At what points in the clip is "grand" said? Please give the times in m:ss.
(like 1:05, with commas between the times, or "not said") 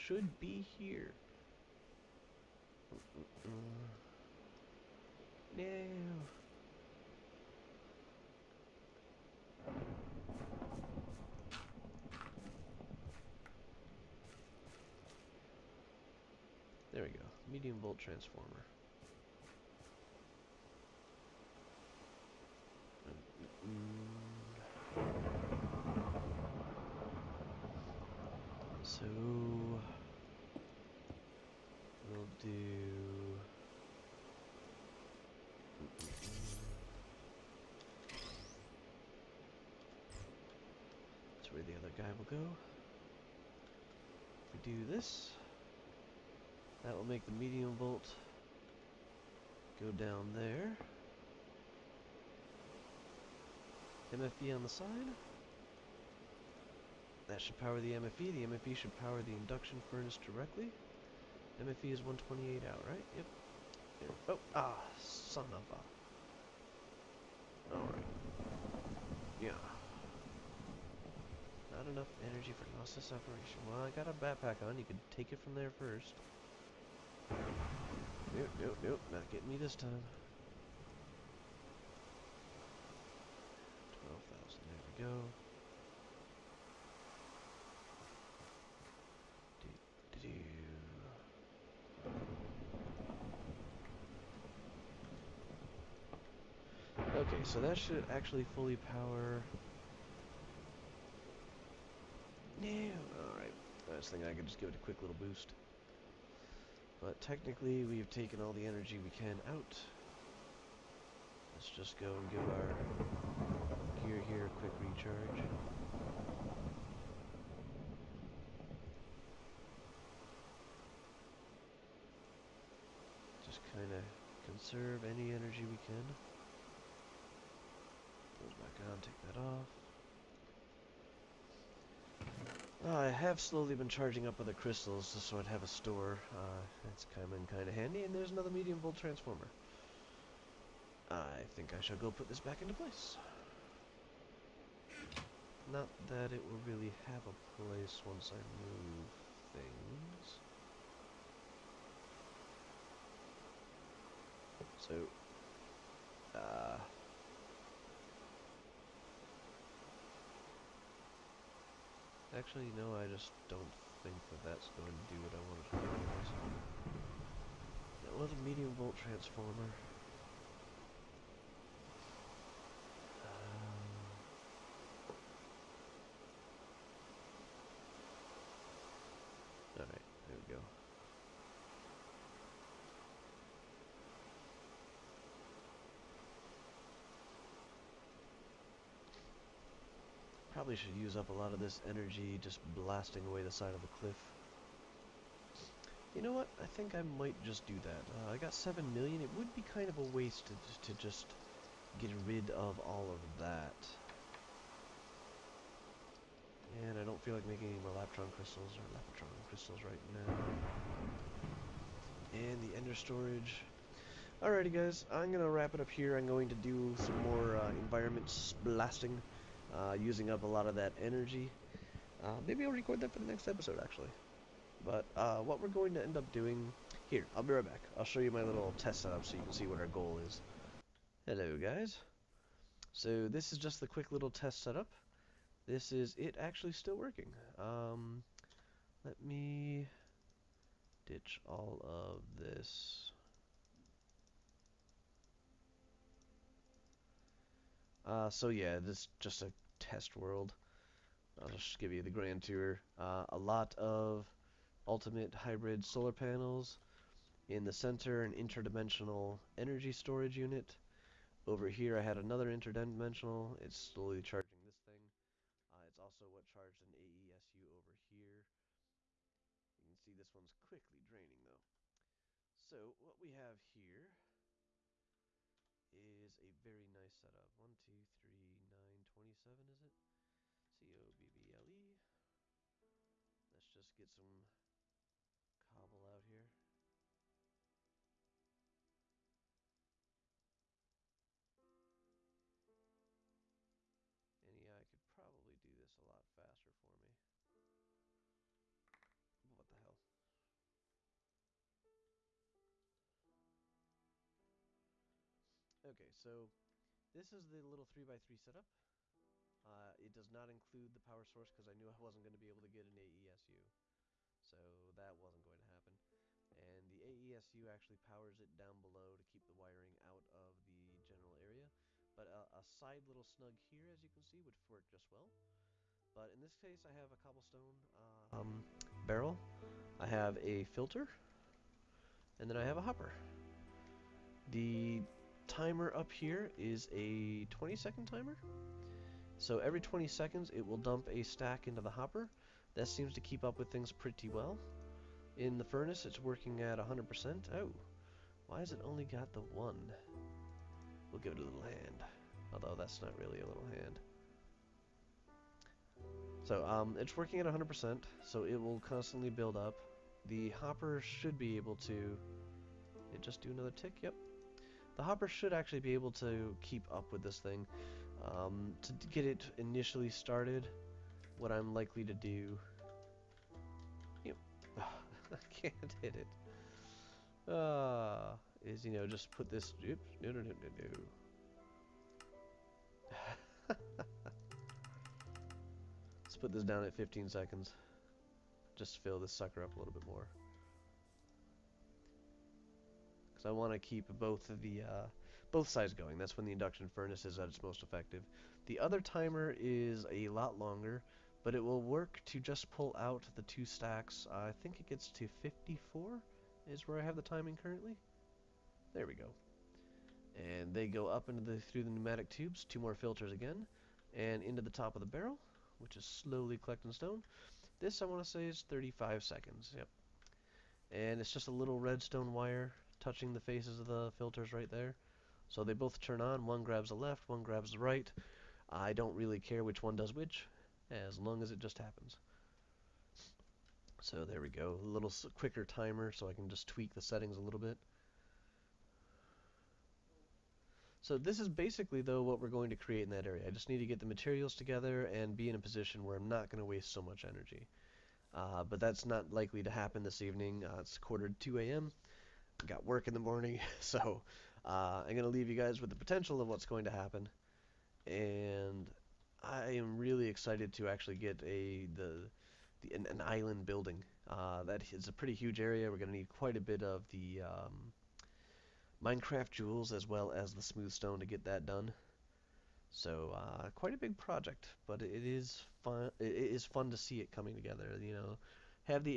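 4:12.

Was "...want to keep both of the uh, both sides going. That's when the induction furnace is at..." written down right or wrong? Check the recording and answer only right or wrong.
right.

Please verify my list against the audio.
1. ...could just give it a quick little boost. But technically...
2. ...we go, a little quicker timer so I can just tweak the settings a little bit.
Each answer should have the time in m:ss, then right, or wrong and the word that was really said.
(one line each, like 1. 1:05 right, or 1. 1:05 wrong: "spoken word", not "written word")
1. 1:44 right
2. 7:14 right.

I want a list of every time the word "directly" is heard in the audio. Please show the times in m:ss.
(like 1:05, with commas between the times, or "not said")
1:00.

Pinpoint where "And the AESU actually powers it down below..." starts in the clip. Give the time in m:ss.
5:16.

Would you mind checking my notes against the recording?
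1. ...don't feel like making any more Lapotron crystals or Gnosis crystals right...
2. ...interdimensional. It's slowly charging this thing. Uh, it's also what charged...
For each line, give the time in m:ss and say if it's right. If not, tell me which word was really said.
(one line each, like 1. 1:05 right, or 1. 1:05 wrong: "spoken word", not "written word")
1. 3:27 wrong: "Lapotron", not "Gnosis"
2. 4:22 right.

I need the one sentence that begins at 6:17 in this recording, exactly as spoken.
Uh, is, you know, just put this...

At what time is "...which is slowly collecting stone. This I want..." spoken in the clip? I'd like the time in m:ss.
6:55.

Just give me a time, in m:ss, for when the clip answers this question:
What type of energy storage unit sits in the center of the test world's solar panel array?
4:18.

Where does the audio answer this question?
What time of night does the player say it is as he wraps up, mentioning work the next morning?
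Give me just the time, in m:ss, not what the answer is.
7:30.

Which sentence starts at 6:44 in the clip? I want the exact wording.
Uh, I think it gets to 54 is where I have the timing currently.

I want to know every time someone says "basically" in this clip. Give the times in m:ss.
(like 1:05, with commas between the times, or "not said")
7:21.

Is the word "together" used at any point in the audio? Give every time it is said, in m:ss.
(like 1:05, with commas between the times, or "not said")
7:24, 7:57.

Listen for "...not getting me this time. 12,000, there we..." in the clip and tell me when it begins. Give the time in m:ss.
1:19.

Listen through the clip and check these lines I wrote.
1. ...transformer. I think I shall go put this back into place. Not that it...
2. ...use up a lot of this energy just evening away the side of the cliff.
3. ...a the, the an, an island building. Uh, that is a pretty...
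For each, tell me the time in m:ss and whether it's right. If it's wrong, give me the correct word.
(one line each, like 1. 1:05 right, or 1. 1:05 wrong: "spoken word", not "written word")
1. 2:18 right
2. 3:11 wrong: "blasting", not "evening"
3. 7:41 right.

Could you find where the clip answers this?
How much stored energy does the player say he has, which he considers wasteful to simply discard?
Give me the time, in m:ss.
3:18.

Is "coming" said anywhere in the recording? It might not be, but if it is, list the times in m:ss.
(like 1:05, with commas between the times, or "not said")
7:57.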